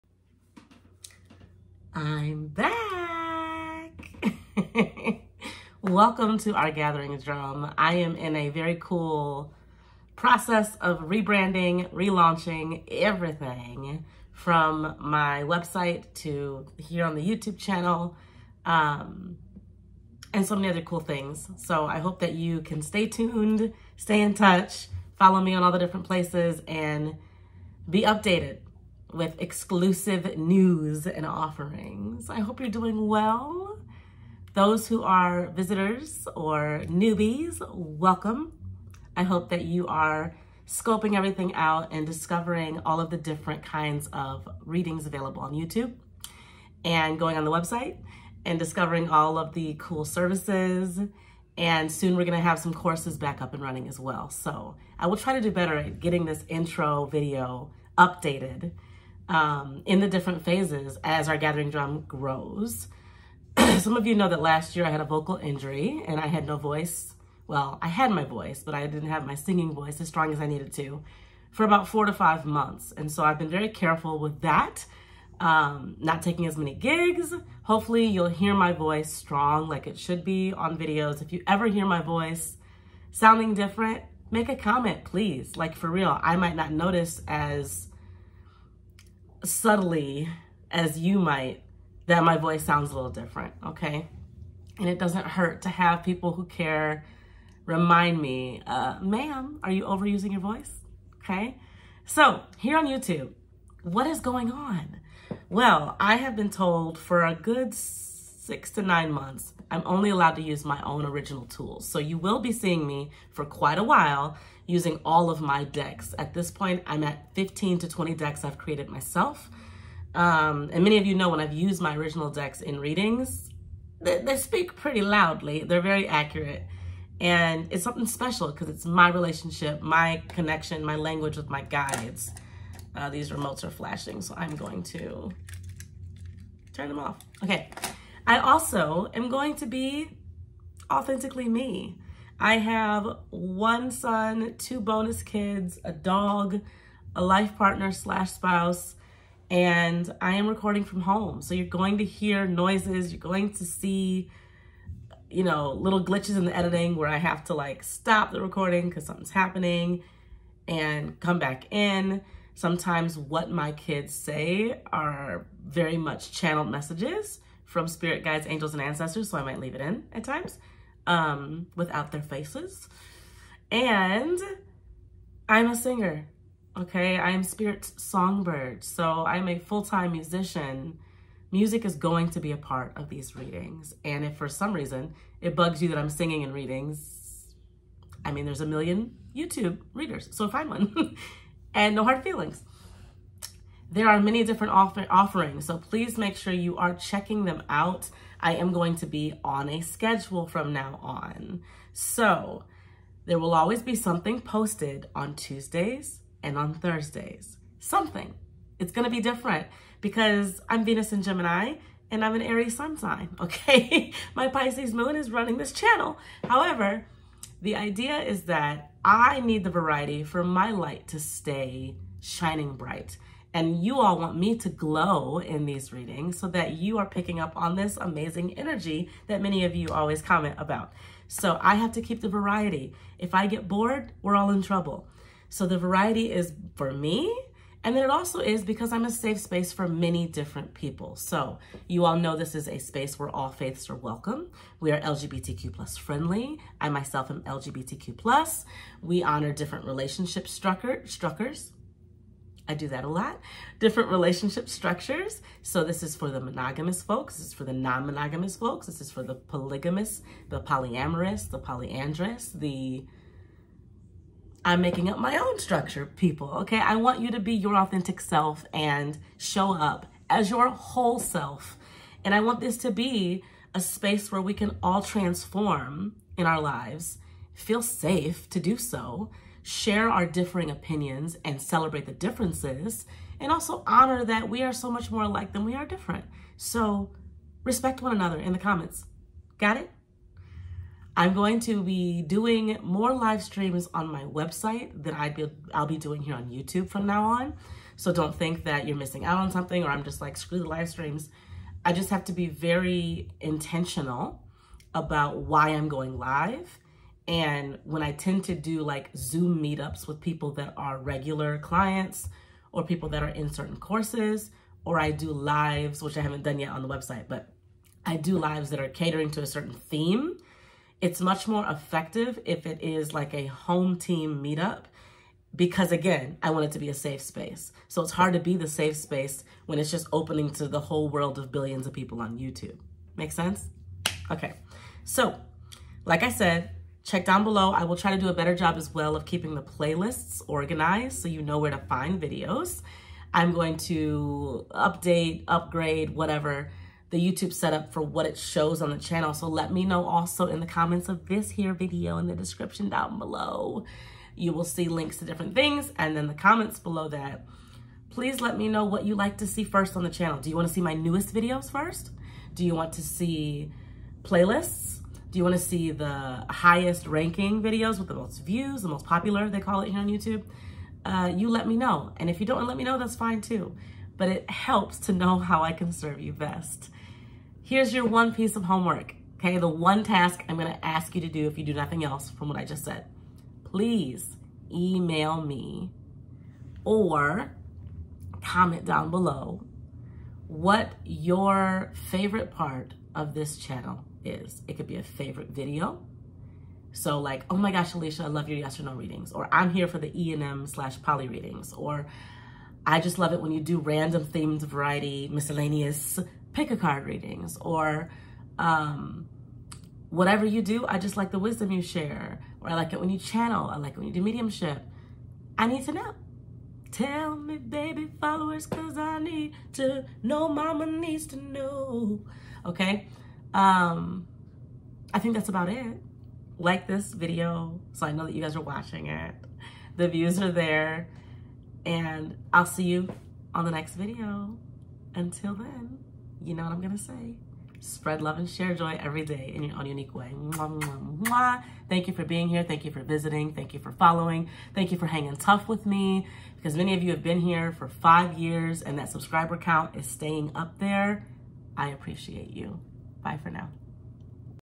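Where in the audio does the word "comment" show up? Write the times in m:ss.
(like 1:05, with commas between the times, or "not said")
1:24, 3:50, 4:48, 5:50, 5:56, 6:28.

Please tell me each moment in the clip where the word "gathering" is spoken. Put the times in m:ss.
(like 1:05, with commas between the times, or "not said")
0:06, 1:01.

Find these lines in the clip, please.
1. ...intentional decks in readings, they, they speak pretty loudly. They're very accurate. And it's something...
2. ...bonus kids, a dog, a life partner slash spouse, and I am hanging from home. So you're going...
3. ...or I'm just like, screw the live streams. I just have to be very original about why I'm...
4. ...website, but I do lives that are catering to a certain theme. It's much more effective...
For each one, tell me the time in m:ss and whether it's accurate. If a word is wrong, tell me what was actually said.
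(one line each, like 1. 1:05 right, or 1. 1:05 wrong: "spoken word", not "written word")
1. 2:01 wrong: "original", not "intentional"
2. 2:24 wrong: "recording", not "hanging"
3. 4:59 wrong: "intentional", not "original"
4. 5:16 right.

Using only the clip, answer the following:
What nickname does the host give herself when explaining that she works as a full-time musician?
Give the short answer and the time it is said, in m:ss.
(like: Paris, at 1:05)
Spirit's songbird, at 2:57.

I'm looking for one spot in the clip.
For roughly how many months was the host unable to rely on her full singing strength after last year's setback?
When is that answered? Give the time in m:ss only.
1:11.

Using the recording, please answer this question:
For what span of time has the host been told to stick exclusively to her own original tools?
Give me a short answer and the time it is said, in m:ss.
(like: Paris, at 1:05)
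6 to 9 months, at 1:48.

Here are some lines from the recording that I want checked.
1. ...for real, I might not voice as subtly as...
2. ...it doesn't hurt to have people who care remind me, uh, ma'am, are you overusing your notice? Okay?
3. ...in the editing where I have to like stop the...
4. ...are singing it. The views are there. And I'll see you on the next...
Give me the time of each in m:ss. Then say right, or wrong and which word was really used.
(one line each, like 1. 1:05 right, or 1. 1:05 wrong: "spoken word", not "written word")
1. 1:25 wrong: "notice", not "voice"
2. 1:34 wrong: "voice", not "notice"
3. 2:36 right
4. 7:08 wrong: "watching", not "singing".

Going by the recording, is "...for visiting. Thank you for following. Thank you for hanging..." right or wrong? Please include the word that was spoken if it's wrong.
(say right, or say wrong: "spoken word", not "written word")
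right.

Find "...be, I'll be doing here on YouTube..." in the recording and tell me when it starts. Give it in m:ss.
4:55.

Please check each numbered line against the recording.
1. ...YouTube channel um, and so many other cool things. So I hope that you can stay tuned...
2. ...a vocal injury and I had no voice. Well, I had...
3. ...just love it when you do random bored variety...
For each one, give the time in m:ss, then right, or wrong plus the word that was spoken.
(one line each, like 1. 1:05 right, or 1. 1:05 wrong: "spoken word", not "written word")
1. 0:17 right
2. 1:04 right
3. 6:42 wrong: "themed", not "bored".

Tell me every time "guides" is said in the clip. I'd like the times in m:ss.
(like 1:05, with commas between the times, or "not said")
2:11, 2:48.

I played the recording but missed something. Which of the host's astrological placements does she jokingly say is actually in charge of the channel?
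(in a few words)
Pisces moon.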